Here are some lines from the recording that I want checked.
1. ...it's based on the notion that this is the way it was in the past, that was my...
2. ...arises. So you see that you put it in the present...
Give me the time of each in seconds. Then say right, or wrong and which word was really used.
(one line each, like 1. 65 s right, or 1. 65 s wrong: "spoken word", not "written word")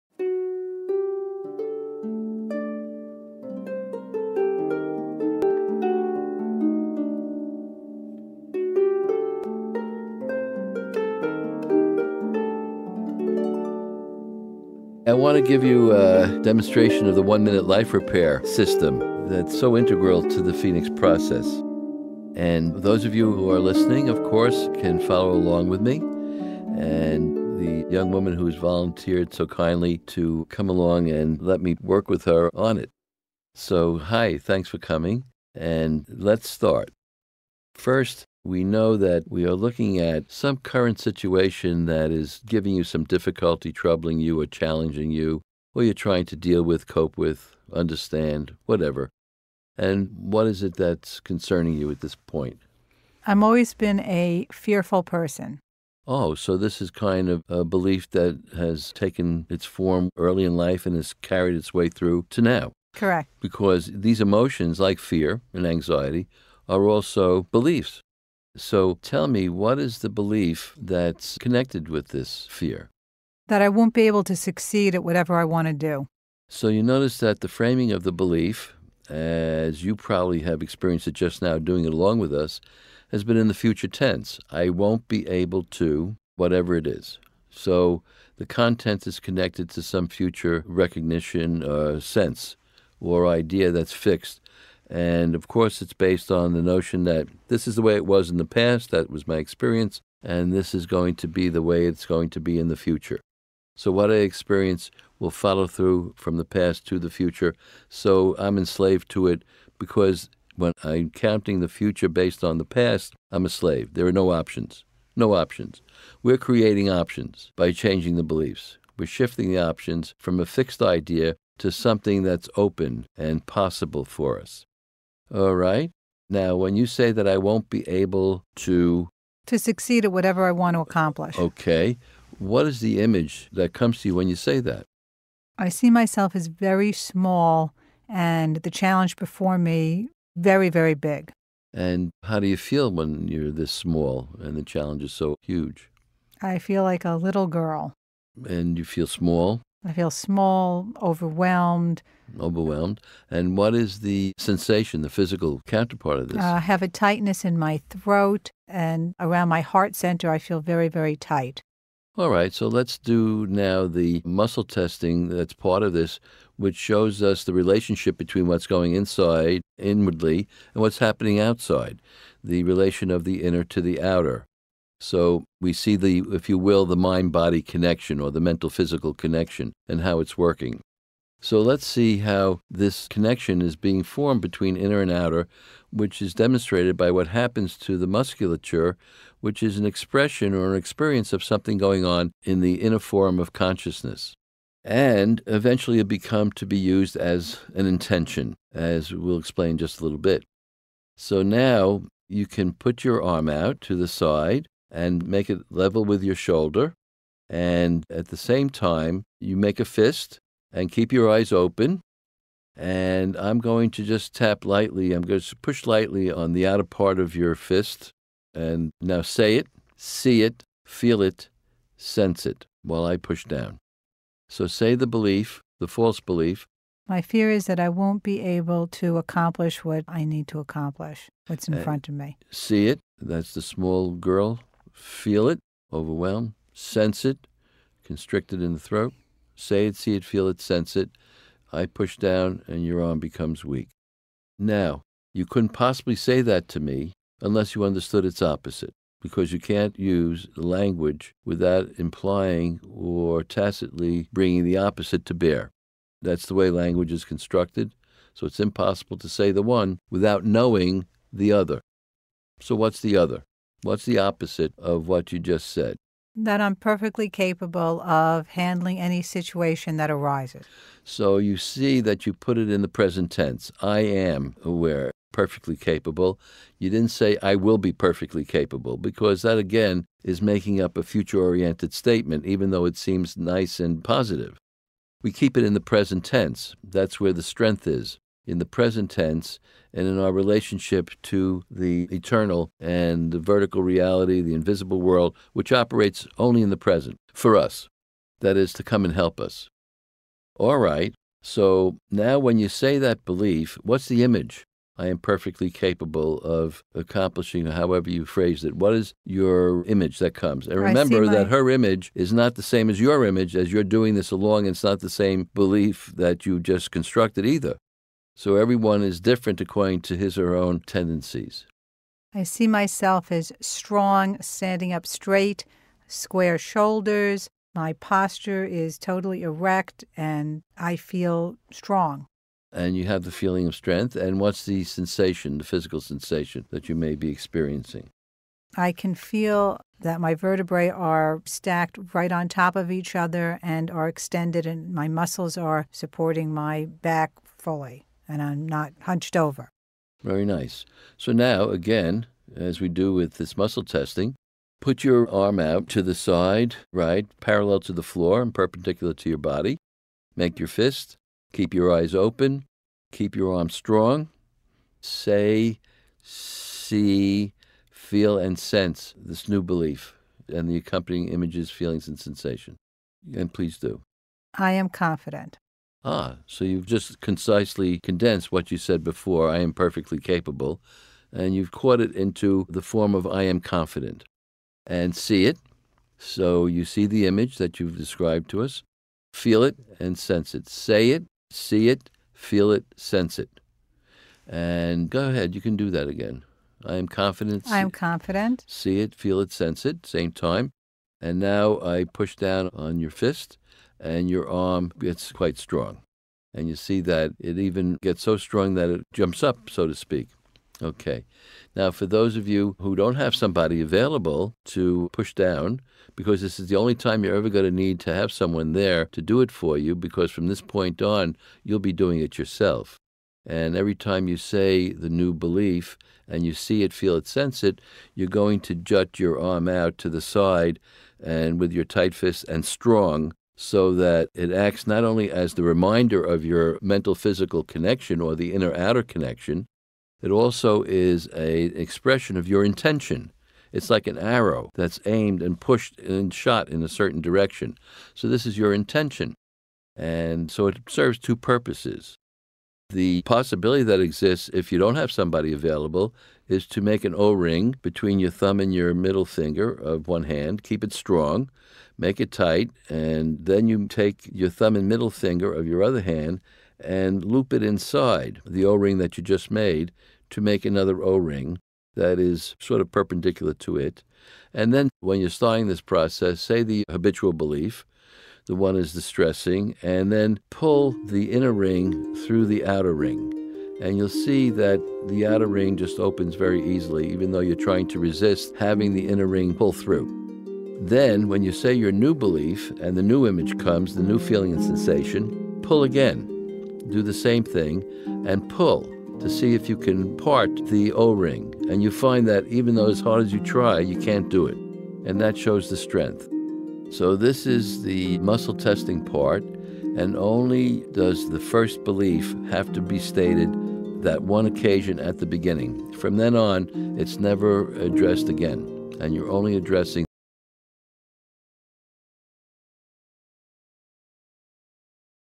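1. 95 s right
2. 270 s right.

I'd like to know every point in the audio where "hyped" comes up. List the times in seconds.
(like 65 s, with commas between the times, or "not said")
not said.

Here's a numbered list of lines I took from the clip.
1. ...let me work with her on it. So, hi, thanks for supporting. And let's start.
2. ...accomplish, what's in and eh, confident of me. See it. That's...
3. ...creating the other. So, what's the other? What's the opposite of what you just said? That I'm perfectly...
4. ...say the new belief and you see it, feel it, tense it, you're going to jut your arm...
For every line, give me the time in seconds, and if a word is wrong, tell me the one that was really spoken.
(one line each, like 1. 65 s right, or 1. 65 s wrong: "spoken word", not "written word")
1. 31 s wrong: "coming", not "supporting"
2. 230 s wrong: "front", not "confident"
3. 260 s wrong: "knowing", not "creating"
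4. 424 s wrong: "sense", not "tense".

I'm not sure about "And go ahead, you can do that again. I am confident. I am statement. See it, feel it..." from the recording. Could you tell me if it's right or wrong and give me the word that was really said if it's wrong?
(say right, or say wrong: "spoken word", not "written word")
wrong: "confident", not "statement".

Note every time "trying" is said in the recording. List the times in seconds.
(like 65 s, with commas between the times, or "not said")
45 s, 487 s.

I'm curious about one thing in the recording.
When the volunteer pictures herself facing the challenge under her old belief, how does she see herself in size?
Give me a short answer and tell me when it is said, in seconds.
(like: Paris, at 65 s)
very small, at 136 s.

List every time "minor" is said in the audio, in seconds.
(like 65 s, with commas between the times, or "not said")
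not said.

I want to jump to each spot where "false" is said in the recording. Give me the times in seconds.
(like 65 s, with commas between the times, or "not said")
225 s.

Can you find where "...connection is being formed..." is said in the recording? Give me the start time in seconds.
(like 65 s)
183 s.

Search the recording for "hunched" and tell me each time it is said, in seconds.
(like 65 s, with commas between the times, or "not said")
349 s.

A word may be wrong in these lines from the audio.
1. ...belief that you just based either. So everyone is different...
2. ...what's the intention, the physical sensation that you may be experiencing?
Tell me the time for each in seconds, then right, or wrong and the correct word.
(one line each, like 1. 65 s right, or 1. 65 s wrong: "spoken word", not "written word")
1. 315 s wrong: "constructed", not "based"
2. 334 s wrong: "sensation", not "intention".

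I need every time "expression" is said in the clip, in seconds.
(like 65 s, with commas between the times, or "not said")
189 s, 441 s.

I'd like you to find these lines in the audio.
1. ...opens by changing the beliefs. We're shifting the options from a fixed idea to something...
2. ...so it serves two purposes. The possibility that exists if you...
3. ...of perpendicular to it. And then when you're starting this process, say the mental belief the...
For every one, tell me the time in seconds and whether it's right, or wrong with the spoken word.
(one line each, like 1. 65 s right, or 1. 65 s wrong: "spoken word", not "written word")
1. 116 s wrong: "options", not "opens"
2. 450 s right
3. 472 s wrong: "habitual", not "mental".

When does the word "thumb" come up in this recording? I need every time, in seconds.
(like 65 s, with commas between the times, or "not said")
458 s, 464 s.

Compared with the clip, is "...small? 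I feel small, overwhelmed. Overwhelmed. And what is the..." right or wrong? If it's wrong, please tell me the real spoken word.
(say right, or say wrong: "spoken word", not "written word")
right.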